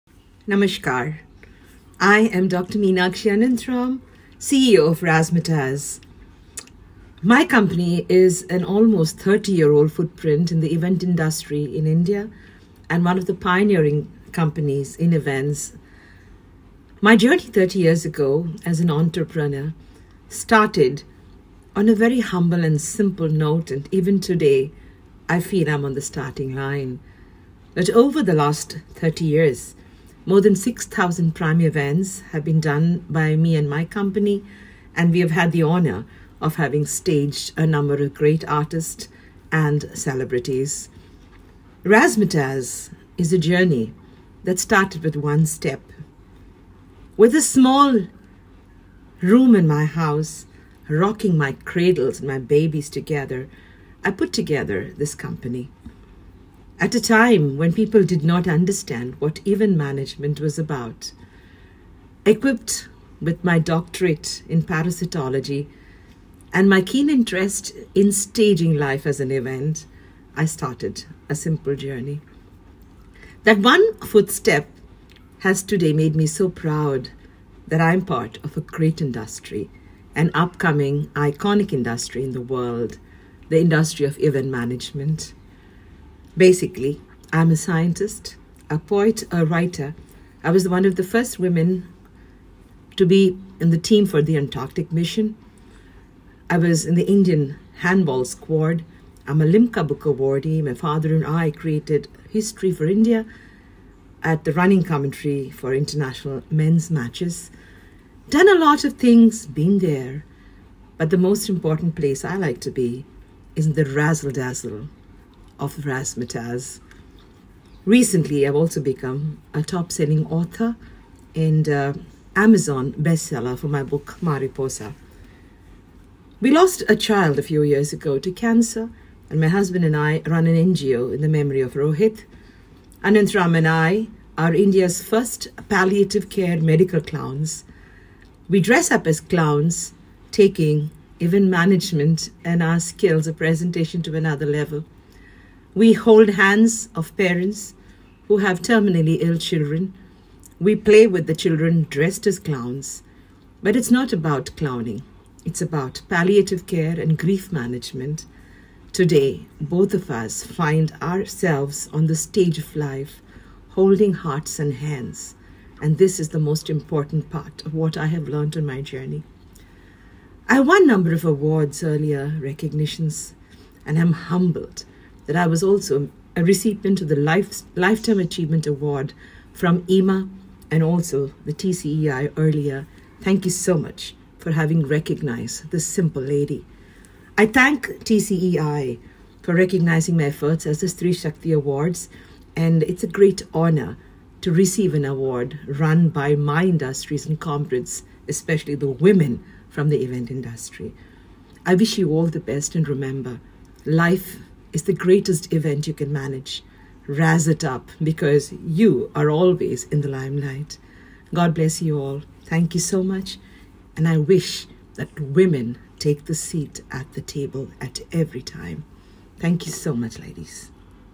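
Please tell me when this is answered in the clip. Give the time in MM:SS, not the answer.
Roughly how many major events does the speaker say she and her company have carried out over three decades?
00:30.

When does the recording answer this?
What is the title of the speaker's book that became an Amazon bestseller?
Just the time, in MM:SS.
02:04.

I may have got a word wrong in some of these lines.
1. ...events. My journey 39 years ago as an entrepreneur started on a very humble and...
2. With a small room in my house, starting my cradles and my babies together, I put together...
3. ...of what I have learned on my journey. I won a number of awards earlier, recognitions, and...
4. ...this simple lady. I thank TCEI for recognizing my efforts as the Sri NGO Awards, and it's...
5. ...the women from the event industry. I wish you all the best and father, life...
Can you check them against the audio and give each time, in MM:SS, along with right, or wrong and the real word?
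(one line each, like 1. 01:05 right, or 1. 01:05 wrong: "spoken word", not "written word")
1. 00:15 wrong: "30", not "39"
2. 00:47 wrong: "rocking", not "starting"
3. 02:47 right
4. 03:05 wrong: "Shakti", not "NGO"
5. 03:18 wrong: "remember", not "father".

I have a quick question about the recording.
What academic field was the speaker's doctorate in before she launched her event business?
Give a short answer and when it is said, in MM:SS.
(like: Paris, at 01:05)
parasitology, at 01:04.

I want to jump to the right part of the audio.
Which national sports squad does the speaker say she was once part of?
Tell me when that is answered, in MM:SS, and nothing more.
01:37.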